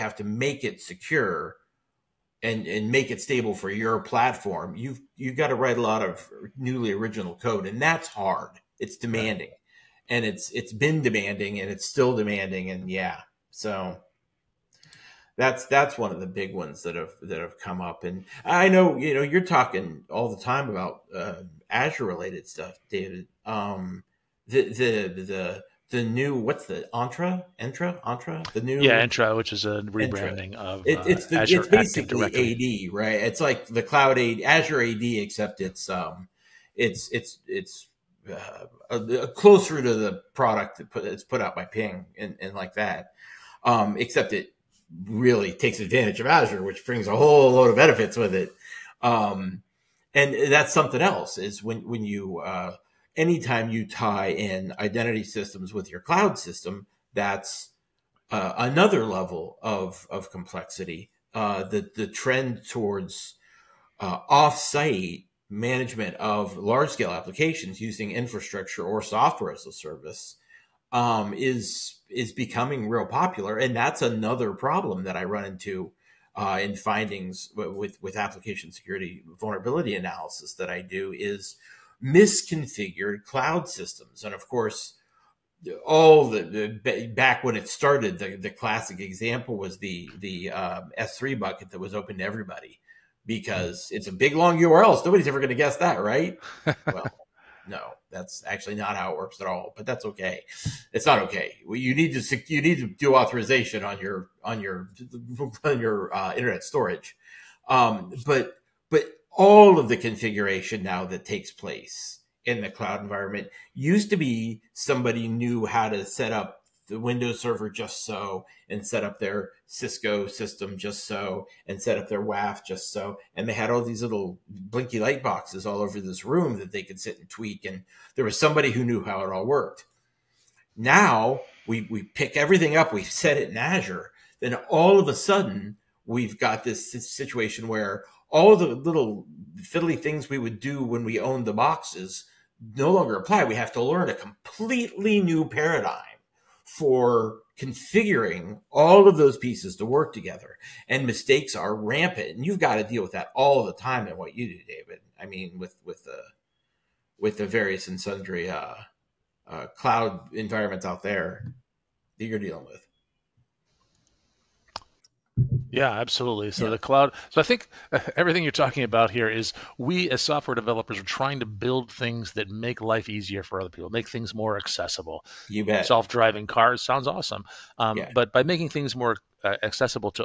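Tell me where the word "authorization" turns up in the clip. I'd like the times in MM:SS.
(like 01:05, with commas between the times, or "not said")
01:43.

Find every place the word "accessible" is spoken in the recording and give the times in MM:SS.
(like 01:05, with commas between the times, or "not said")
02:54, 02:59.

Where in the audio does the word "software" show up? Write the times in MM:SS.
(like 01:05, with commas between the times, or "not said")
01:09, 02:50.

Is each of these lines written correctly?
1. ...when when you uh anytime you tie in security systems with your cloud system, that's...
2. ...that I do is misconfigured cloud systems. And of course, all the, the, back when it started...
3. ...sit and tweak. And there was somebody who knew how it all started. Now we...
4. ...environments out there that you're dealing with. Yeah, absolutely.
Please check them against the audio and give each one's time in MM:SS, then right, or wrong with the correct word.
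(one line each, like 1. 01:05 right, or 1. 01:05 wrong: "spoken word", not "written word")
1. 00:51 wrong: "identity", not "security"
2. 01:20 right
3. 02:06 wrong: "worked", not "started"
4. 02:40 right.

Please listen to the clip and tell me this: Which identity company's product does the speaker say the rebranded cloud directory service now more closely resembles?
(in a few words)
Ping.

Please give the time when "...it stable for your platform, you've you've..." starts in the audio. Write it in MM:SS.
00:03.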